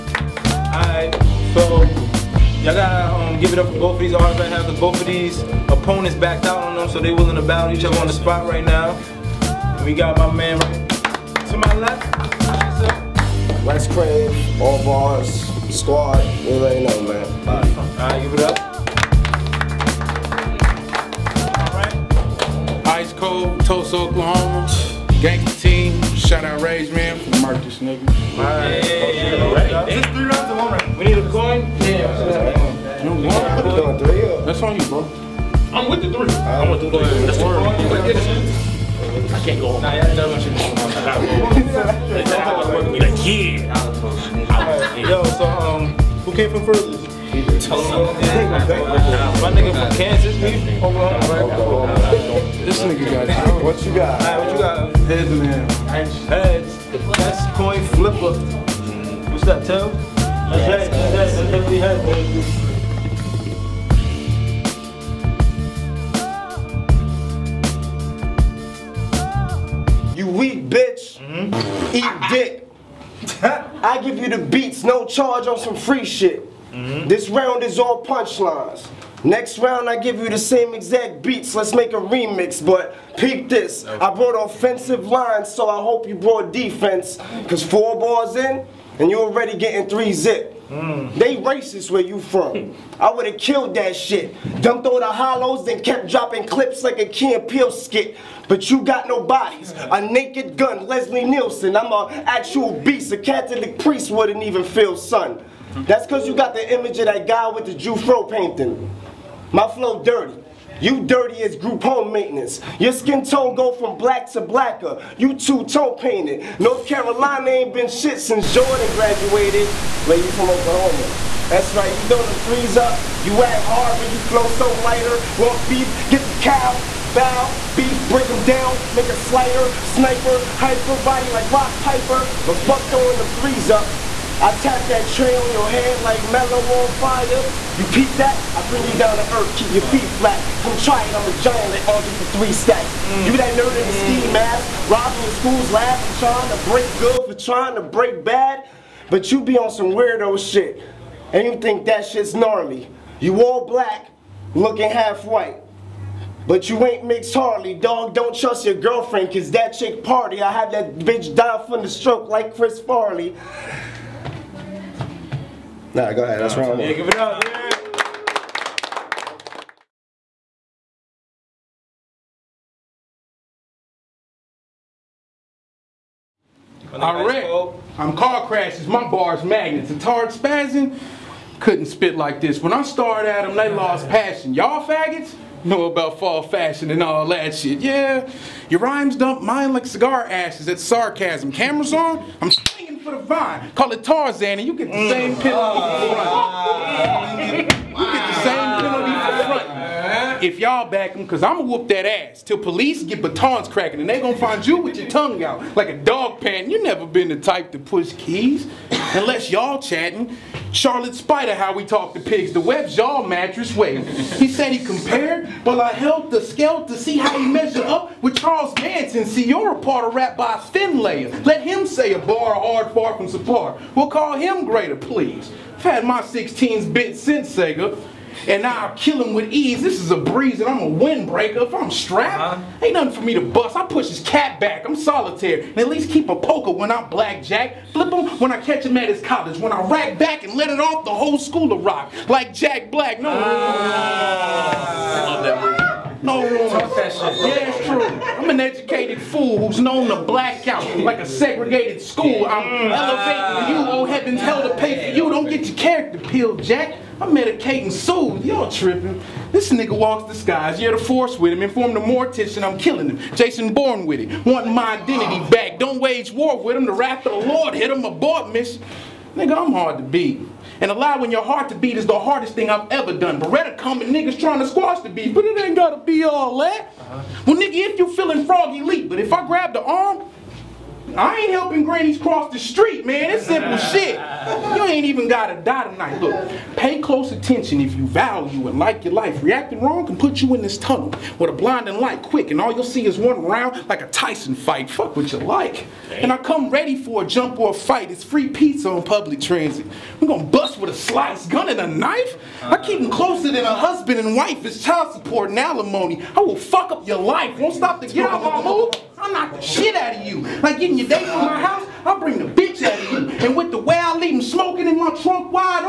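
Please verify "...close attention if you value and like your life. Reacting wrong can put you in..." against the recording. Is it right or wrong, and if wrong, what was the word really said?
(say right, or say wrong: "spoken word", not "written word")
right.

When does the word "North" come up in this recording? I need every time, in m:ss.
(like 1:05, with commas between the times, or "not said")
1:56.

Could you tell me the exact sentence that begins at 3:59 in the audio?
When I rack back and let it off, the whole school of rock like Jack Black.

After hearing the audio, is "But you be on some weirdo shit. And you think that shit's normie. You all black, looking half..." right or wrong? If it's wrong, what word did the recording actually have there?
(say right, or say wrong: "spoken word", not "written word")
right.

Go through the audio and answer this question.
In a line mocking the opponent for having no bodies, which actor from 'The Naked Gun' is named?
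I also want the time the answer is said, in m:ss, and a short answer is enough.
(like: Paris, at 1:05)
Leslie Nielsen, at 1:40.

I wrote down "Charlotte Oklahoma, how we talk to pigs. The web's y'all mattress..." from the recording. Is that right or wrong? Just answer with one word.
wrong.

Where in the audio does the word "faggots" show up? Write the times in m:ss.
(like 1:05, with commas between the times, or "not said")
3:04.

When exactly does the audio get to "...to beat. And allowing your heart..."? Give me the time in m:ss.
4:29.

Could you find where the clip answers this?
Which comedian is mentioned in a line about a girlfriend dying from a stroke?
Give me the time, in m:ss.
2:42.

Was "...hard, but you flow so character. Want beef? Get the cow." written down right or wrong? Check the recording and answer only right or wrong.
wrong.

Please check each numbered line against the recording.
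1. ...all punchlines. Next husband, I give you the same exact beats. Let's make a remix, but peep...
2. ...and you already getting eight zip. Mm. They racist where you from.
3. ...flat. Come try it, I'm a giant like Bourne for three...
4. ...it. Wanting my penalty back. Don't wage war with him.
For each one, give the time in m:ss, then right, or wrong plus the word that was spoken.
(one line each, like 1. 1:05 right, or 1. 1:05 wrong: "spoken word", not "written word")
1. 1:17 wrong: "round", not "husband"
2. 1:28 wrong: "three", not "eight"
3. 2:20 wrong: "Andre", not "Bourne"
4. 4:24 wrong: "identity", not "penalty".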